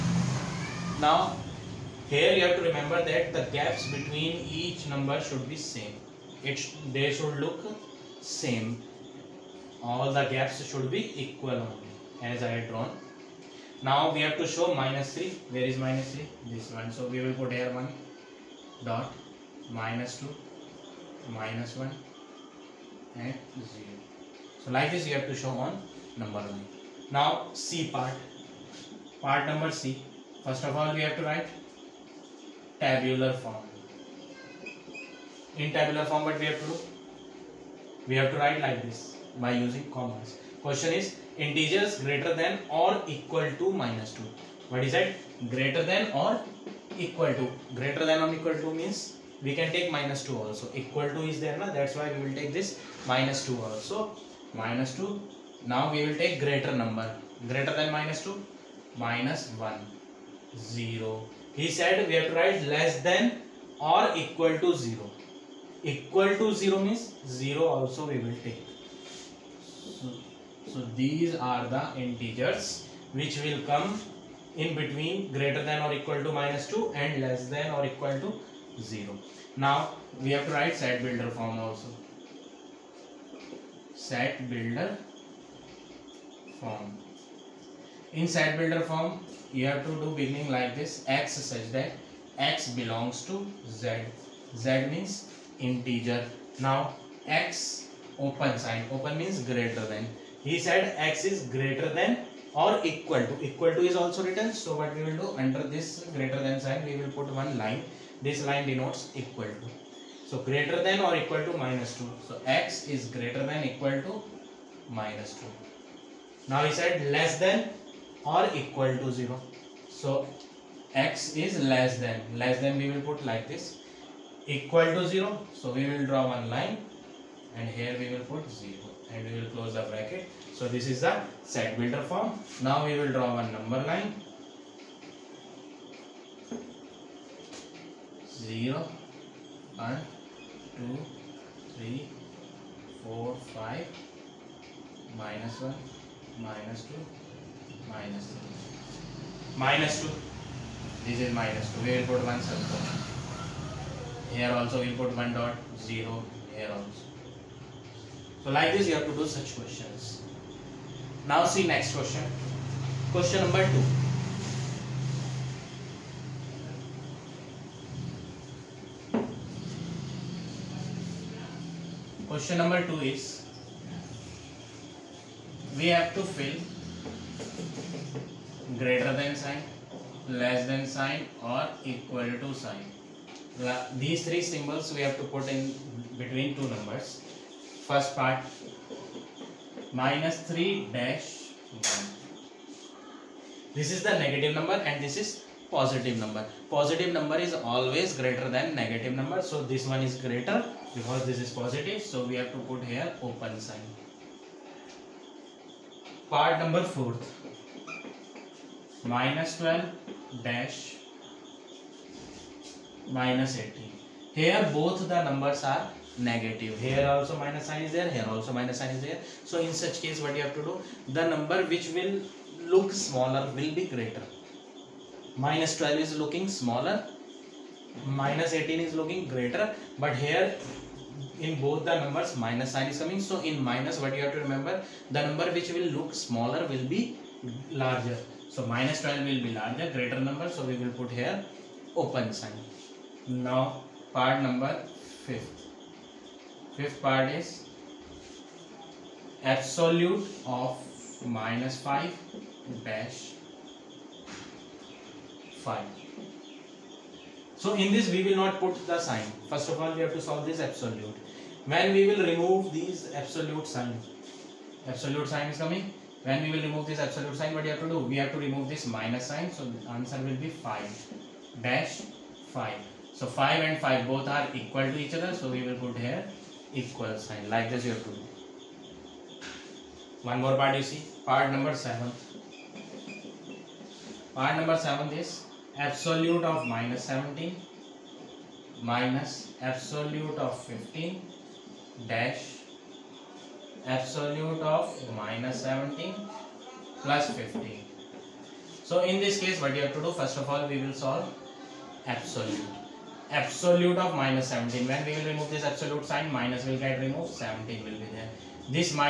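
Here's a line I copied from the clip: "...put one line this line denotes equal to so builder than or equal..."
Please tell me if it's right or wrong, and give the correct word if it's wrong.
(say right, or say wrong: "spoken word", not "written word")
wrong: "greater", not "builder".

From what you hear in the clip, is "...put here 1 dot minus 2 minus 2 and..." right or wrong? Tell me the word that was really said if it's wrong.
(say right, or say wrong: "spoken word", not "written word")
wrong: "1", not "2".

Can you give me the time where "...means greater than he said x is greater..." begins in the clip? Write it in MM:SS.
01:39.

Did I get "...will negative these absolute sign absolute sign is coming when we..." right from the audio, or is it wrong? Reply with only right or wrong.
wrong.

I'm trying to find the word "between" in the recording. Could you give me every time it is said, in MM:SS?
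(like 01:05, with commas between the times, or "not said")
00:03, 01:14, 03:06.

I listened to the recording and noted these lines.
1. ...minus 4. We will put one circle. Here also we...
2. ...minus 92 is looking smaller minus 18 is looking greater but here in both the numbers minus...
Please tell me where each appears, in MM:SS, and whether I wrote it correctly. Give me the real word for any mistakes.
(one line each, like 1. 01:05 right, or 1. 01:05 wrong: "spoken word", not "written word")
1. 02:31 wrong: "2", not "4"
2. 03:45 wrong: "12", not "92".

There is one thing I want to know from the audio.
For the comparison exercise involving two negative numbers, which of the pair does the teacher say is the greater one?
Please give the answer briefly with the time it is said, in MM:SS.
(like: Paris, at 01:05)
-12, at 03:58.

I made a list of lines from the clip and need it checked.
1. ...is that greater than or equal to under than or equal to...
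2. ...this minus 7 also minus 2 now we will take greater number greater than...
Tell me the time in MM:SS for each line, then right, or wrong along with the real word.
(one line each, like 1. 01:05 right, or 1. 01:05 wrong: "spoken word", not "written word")
1. 00:44 wrong: "greater", not "under"
2. 00:52 wrong: "2", not "7".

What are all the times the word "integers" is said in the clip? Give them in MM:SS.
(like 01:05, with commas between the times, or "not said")
00:41, 01:11, 01:35.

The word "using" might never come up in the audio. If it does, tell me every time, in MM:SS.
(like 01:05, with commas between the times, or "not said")
00:39.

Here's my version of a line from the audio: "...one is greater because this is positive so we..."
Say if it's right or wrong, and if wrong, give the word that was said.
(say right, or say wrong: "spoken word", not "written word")
right.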